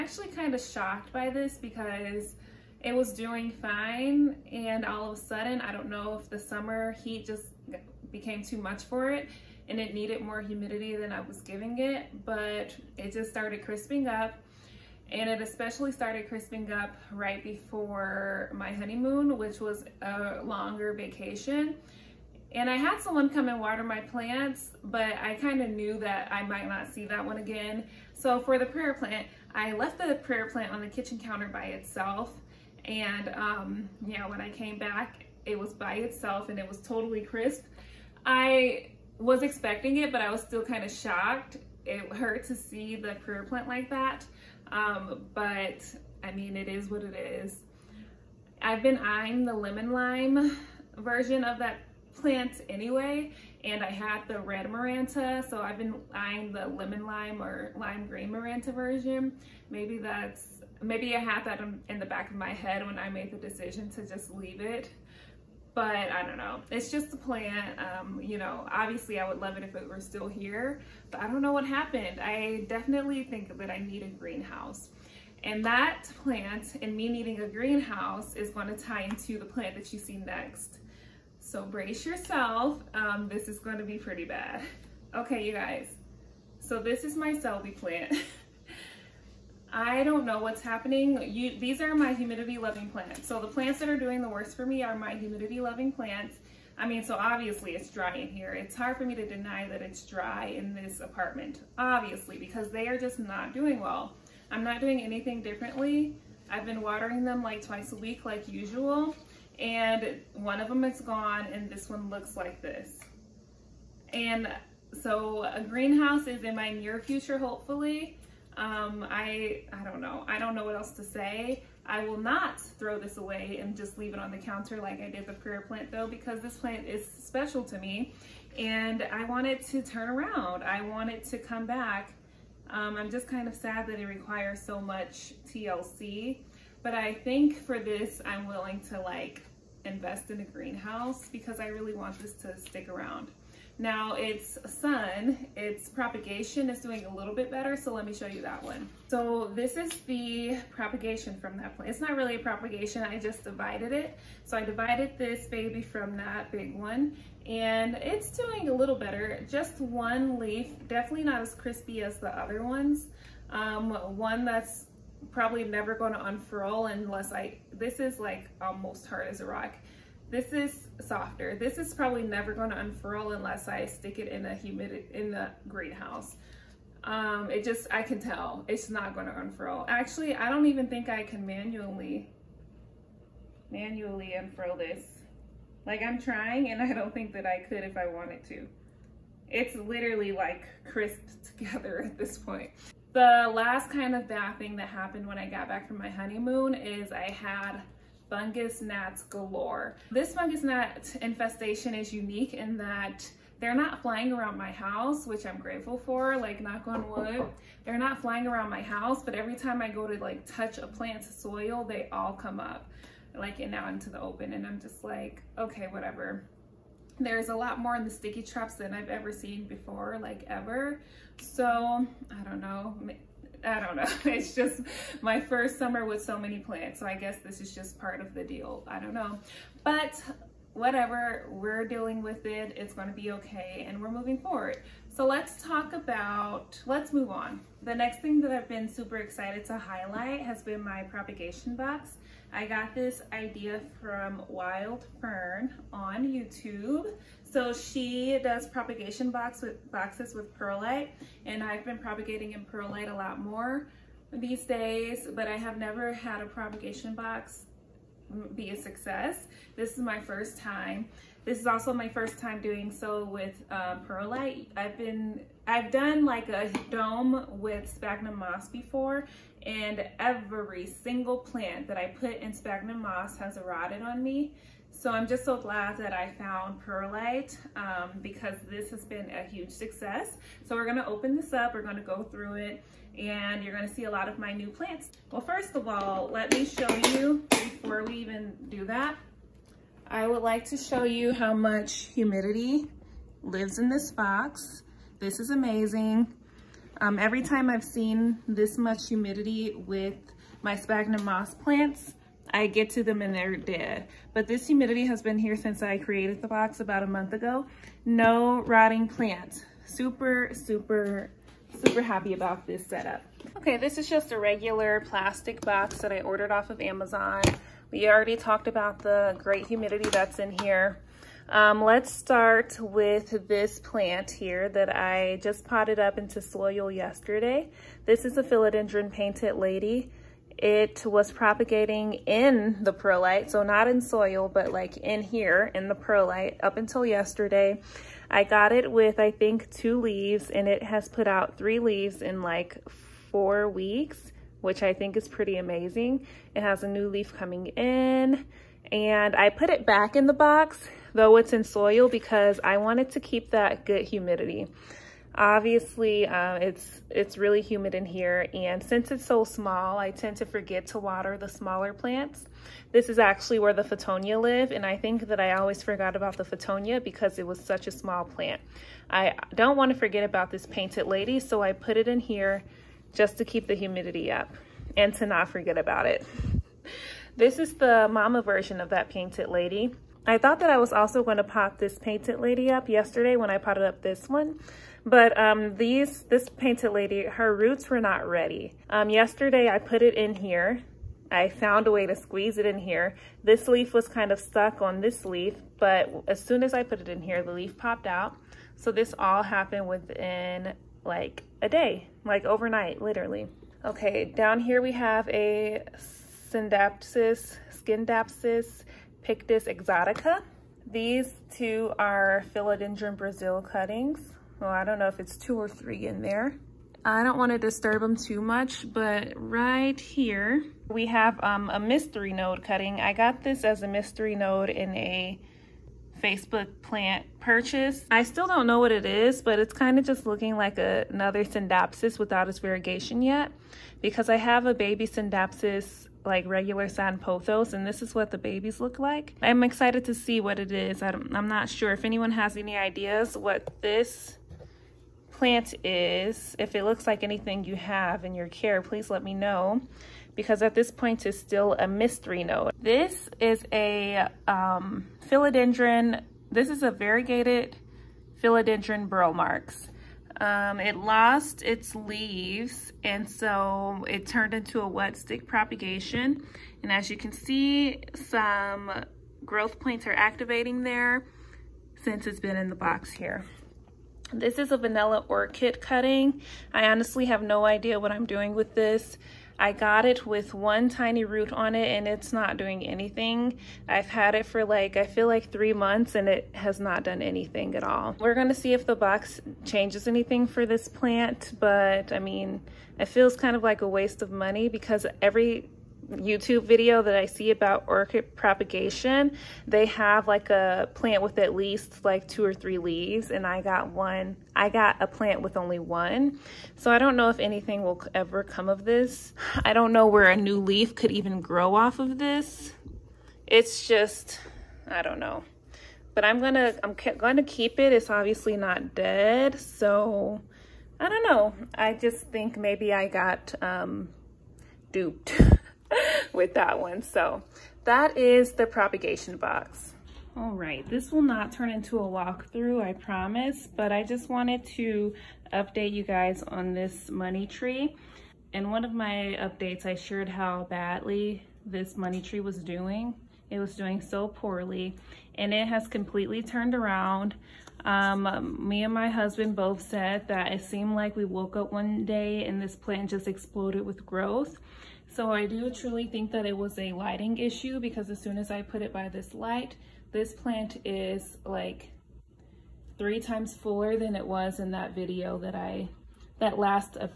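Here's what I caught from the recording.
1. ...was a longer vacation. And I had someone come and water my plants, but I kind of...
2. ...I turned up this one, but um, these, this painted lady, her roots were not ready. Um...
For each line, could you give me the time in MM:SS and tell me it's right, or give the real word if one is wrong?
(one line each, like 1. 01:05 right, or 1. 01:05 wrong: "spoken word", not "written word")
1. 00:19 right
2. 06:23 wrong: "potted", not "turned".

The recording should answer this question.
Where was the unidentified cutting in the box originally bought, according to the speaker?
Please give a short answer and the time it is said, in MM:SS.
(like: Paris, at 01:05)
Facebook, at 07:06.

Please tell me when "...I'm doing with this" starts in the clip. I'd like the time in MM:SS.
07:58.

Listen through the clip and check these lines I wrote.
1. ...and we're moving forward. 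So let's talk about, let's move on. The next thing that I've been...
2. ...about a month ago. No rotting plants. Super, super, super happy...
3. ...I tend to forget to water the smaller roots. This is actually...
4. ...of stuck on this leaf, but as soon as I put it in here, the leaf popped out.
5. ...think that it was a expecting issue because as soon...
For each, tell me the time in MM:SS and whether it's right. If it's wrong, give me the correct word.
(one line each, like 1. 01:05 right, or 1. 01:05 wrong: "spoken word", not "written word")
1. 03:53 right
2. 05:06 right
3. 05:59 wrong: "plants", not "roots"
4. 06:34 right
5. 09:16 wrong: "lighting", not "expecting".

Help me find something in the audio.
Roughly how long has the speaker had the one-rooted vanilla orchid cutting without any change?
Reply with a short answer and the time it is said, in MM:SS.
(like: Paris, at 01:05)
3 months, at 08:05.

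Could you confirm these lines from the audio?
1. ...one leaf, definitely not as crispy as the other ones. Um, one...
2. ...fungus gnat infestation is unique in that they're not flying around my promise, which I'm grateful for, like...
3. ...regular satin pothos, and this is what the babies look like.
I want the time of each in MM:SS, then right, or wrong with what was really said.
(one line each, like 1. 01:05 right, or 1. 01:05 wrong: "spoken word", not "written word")
1. 02:39 right
2. 03:20 wrong: "house", not "promise"
3. 07:16 right.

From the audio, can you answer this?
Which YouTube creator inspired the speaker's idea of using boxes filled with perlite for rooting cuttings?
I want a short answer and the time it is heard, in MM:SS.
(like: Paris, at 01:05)
Wild Fern, at 04:04.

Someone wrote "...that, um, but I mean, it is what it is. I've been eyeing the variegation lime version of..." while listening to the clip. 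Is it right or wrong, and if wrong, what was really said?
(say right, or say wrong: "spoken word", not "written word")
wrong: "lemon", not "variegation".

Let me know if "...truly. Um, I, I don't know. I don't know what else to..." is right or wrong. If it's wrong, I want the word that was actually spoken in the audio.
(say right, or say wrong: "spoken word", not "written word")
wrong: "hopefully", not "truly".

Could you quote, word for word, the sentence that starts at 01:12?
I definitely think that I need a greenhouse.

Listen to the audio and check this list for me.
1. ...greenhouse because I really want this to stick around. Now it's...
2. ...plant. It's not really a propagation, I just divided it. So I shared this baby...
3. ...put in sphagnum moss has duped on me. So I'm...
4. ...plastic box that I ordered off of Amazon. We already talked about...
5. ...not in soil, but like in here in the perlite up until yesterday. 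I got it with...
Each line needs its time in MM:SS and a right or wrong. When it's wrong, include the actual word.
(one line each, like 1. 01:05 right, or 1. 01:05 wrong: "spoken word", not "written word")
1. 02:20 right
2. 02:31 wrong: "divided", not "shared"
3. 04:32 wrong: "rotted", not "duped"
4. 05:15 right
5. 05:33 right.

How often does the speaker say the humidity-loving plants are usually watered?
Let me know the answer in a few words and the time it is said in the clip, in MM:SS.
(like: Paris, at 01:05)
Twice a week, at 01:47.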